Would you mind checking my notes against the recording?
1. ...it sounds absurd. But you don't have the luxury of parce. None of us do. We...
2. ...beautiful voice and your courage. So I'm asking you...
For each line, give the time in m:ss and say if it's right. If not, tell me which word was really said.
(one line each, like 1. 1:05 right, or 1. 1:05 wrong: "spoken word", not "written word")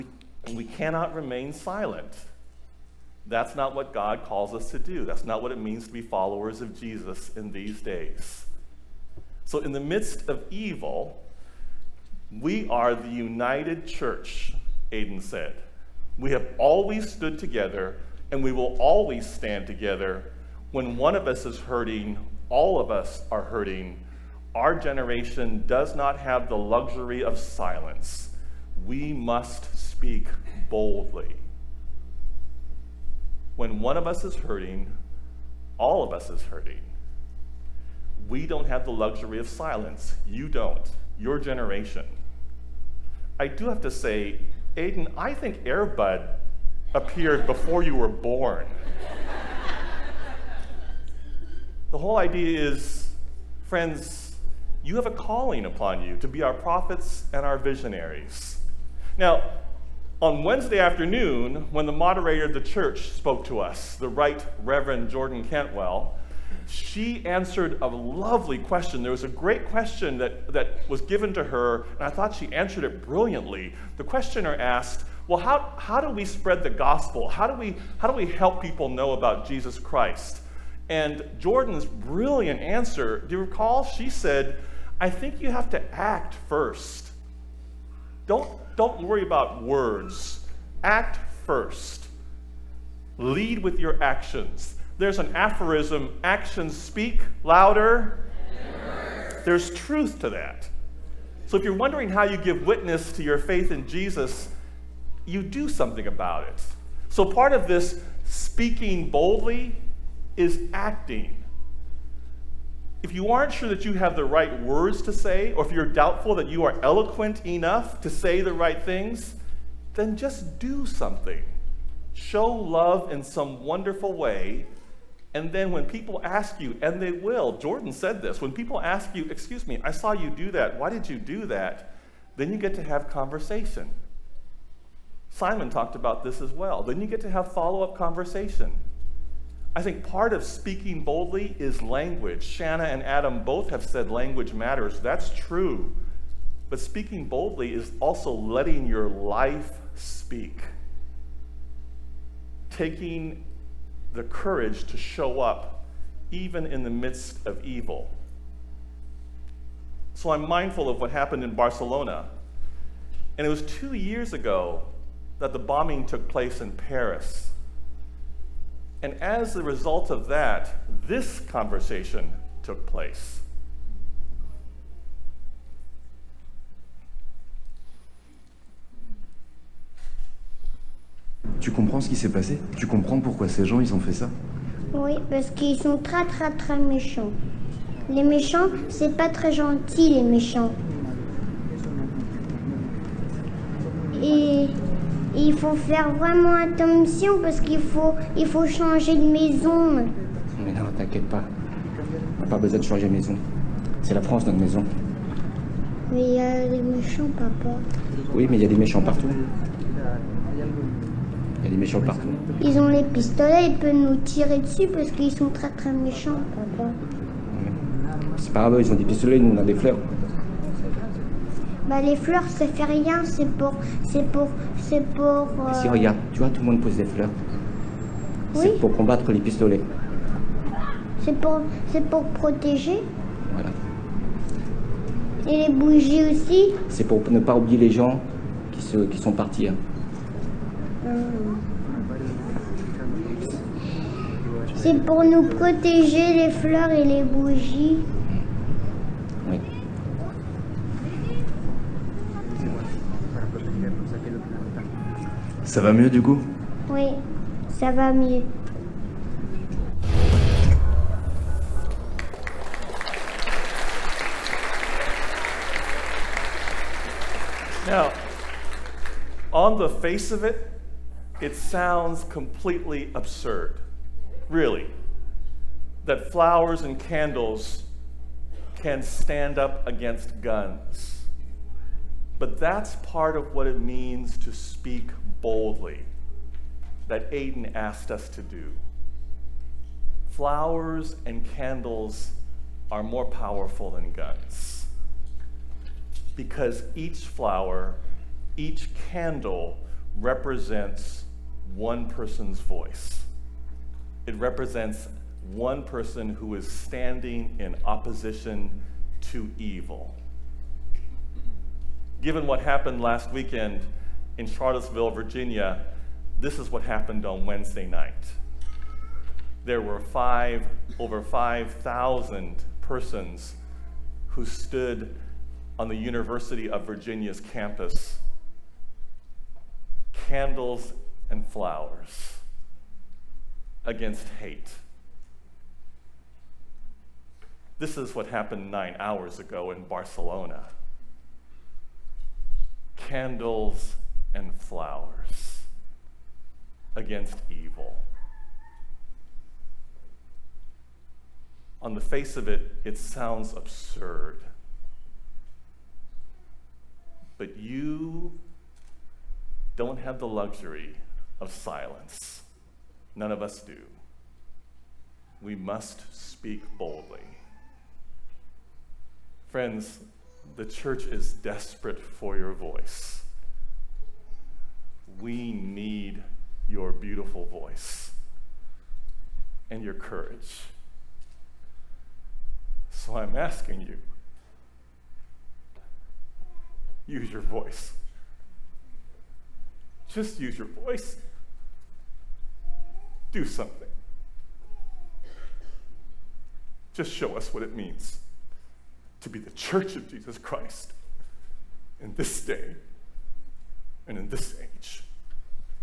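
1. 5:52 wrong: "silence", not "parce"
2. 6:16 right.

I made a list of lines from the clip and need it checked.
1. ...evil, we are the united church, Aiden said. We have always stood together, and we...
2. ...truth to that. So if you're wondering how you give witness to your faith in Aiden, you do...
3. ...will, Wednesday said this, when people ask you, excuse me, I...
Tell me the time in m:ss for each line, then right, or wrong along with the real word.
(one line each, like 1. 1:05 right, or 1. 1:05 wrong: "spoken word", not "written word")
1. 0:10 right
2. 1:39 wrong: "Jesus", not "Aiden"
3. 2:07 wrong: "Jordan", not "Wednesday".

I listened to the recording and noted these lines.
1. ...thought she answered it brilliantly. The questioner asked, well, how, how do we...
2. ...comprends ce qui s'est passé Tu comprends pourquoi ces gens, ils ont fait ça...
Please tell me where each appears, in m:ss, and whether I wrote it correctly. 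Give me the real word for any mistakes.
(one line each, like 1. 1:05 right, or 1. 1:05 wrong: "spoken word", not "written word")
1. 1:12 right
2. 3:01 right.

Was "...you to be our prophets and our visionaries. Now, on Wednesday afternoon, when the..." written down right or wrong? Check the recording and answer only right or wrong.
right.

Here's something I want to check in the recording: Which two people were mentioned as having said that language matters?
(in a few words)
Shanna and Adam.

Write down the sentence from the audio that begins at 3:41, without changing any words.
Bah, les fleurs, ça fait rien, c'est pour.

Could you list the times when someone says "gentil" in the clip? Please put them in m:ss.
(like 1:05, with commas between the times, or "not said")
3:09.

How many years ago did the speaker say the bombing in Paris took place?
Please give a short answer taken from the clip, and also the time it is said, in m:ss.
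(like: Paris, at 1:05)
2, at 2:43.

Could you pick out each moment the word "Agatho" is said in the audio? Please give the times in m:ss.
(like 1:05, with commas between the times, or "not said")
not said.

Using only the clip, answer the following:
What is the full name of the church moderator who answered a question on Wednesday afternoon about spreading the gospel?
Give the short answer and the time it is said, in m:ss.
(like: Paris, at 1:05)
Jordan Cantwell, at 1:05.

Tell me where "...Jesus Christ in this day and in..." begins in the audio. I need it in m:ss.
6:40.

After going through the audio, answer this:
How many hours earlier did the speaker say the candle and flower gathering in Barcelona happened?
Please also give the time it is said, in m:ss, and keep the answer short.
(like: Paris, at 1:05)
9, at 5:38.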